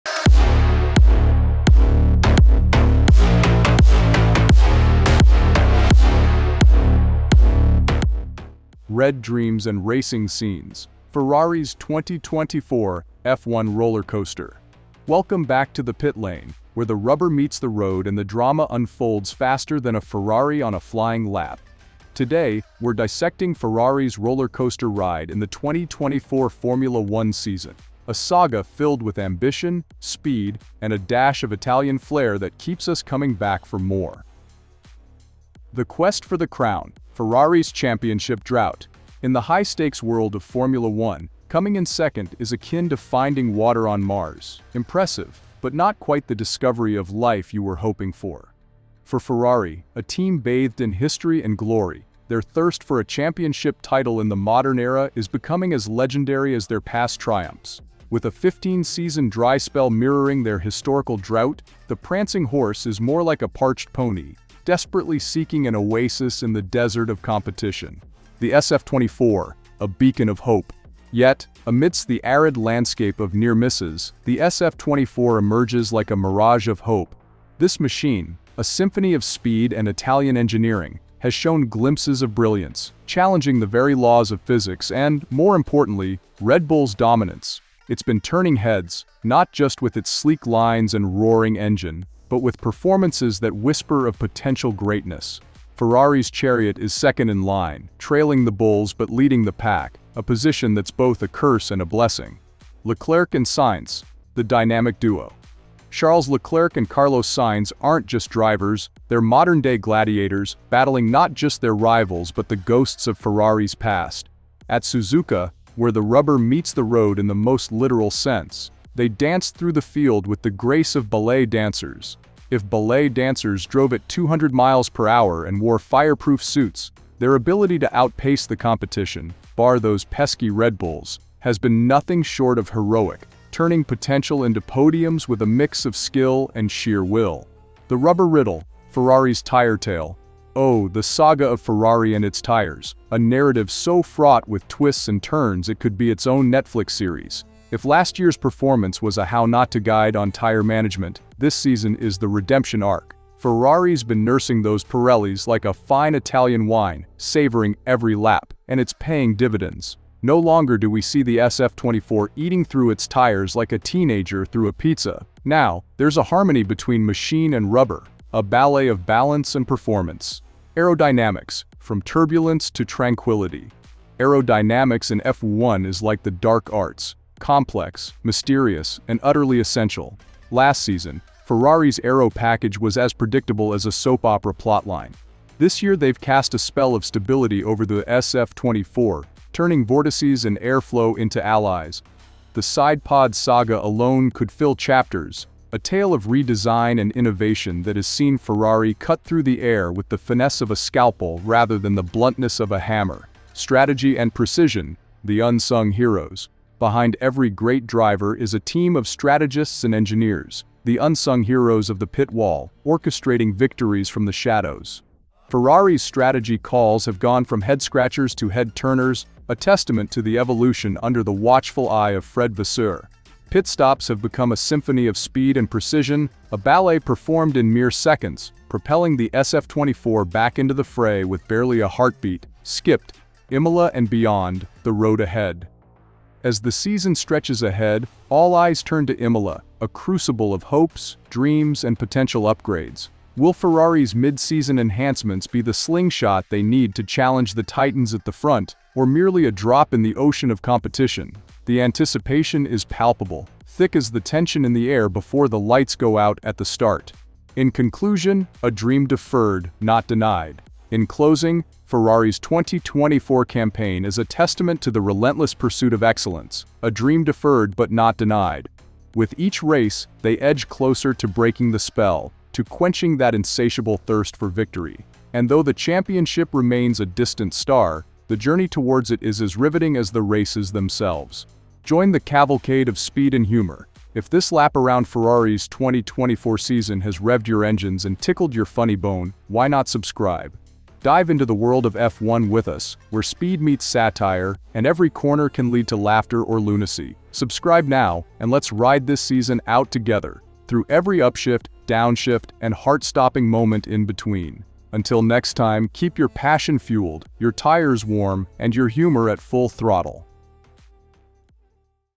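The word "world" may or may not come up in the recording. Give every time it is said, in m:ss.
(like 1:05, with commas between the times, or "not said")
0:40, 4:51.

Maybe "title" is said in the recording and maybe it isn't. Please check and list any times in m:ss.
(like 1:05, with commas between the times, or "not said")
0:53.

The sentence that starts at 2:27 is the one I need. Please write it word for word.
If last year's performance was a how not to guide on tire management, this season is the redemption arc.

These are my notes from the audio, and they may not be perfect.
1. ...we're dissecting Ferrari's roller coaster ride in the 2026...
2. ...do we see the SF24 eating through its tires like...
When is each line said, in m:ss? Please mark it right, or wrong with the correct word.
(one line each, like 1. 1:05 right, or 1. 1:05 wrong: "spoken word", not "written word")
1. 0:22 wrong: "2024", not "2026"
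2. 2:40 right.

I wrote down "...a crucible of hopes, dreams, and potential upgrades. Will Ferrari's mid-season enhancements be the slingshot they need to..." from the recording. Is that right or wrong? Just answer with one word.
right.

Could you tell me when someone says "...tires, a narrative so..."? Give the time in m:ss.
2:22.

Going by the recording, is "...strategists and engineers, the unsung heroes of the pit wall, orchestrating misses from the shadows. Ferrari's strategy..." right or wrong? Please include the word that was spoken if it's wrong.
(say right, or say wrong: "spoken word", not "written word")
wrong: "victories", not "misses".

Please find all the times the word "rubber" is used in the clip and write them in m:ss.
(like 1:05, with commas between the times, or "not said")
0:16, 1:56, 2:17, 2:47.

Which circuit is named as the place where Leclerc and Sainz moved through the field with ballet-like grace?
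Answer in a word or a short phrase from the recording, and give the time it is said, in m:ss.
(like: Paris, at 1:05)
Suzuka, at 1:54.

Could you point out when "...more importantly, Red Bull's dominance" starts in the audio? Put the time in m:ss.
1:25.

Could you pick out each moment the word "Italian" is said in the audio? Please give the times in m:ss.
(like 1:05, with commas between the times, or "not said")
0:31, 1:19, 2:36.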